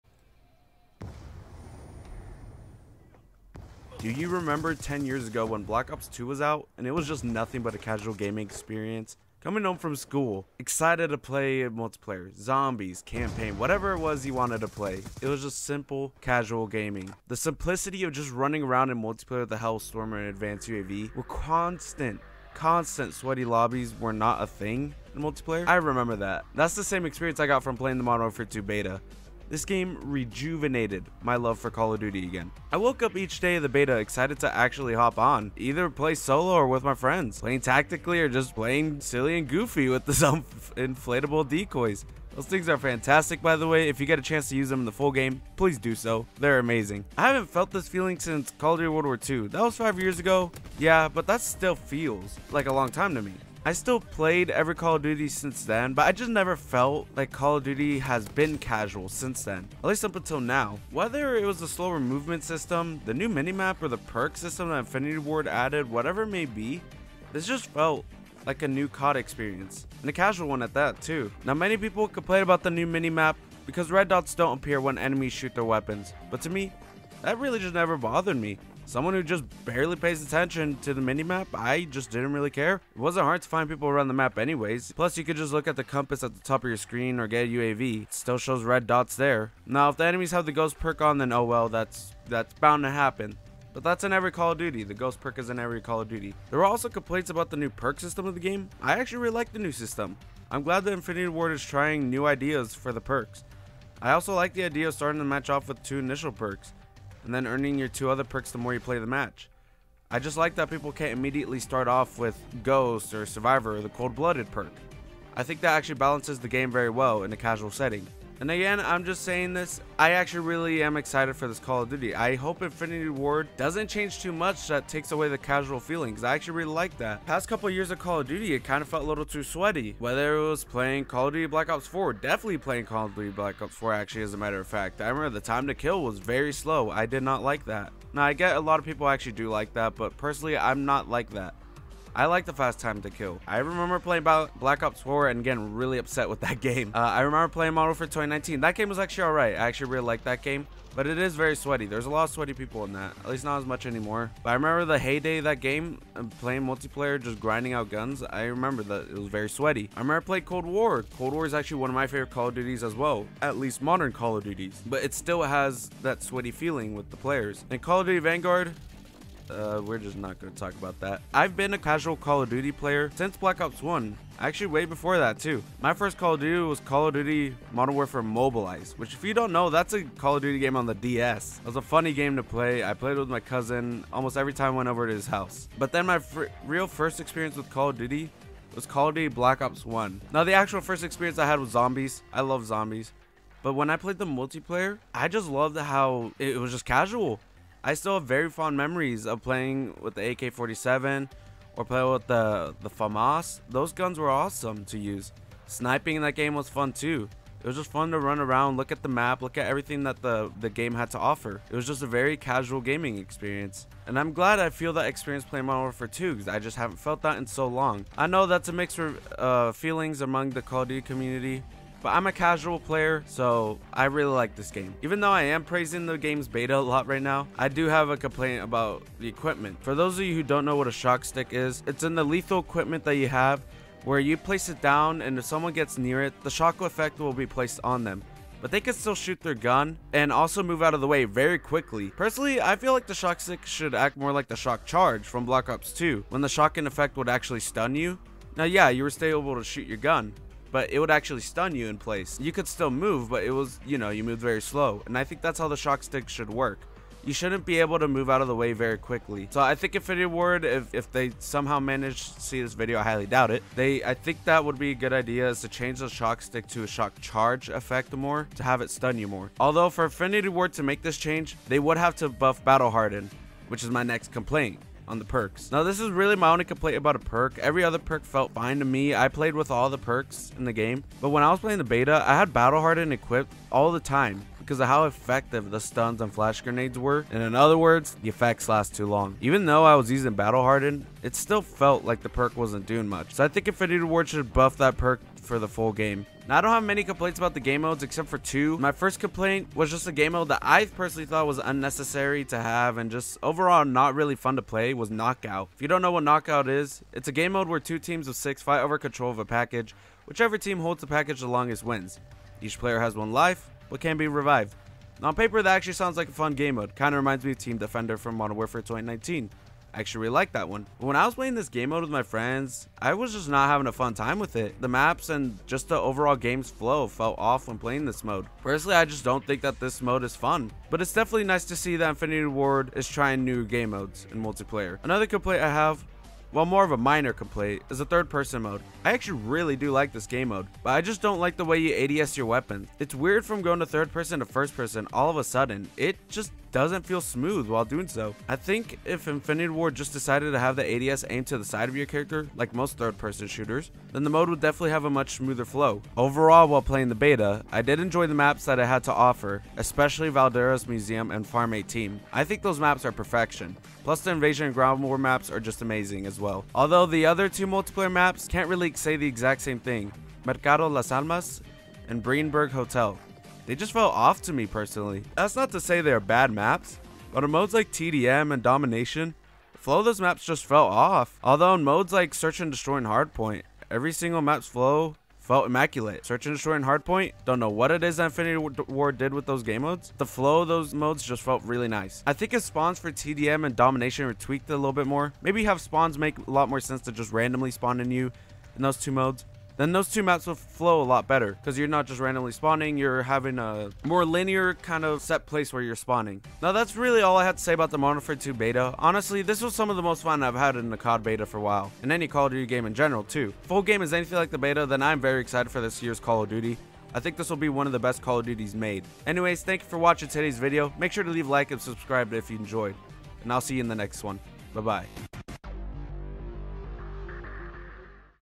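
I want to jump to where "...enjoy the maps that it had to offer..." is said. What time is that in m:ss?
5:57.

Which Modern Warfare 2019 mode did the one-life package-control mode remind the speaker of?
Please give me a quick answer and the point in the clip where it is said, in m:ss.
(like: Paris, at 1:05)
Team Defender, at 5:17.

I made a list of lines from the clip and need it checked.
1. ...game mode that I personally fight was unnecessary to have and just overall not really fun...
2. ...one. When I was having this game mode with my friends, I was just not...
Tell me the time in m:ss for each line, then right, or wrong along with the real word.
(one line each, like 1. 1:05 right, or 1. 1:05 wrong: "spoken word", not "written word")
1. 5:00 wrong: "thought", not "fight"
2. 5:20 wrong: "playing", not "having".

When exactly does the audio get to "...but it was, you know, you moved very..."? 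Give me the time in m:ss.
4:13.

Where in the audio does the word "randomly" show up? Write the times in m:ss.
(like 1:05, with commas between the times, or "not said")
6:37, 6:42.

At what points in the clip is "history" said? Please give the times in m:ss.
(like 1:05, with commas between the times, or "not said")
not said.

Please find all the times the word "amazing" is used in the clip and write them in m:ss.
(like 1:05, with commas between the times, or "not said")
0:46, 6:05.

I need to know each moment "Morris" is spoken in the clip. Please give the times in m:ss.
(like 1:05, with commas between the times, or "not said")
not said.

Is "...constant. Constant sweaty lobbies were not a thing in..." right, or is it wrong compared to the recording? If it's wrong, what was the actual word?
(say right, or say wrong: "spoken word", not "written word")
right.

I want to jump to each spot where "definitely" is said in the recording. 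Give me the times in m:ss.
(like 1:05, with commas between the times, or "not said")
2:12, 5:31, 5:54.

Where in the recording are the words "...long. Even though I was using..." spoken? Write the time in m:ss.
4:49.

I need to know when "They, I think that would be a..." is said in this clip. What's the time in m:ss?
4:23.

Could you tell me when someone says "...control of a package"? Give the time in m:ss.
5:08.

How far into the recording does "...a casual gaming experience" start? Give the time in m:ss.
0:07.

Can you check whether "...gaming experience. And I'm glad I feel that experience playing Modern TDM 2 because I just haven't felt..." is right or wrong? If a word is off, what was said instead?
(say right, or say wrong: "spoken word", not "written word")
wrong: "Warfare", not "TDM".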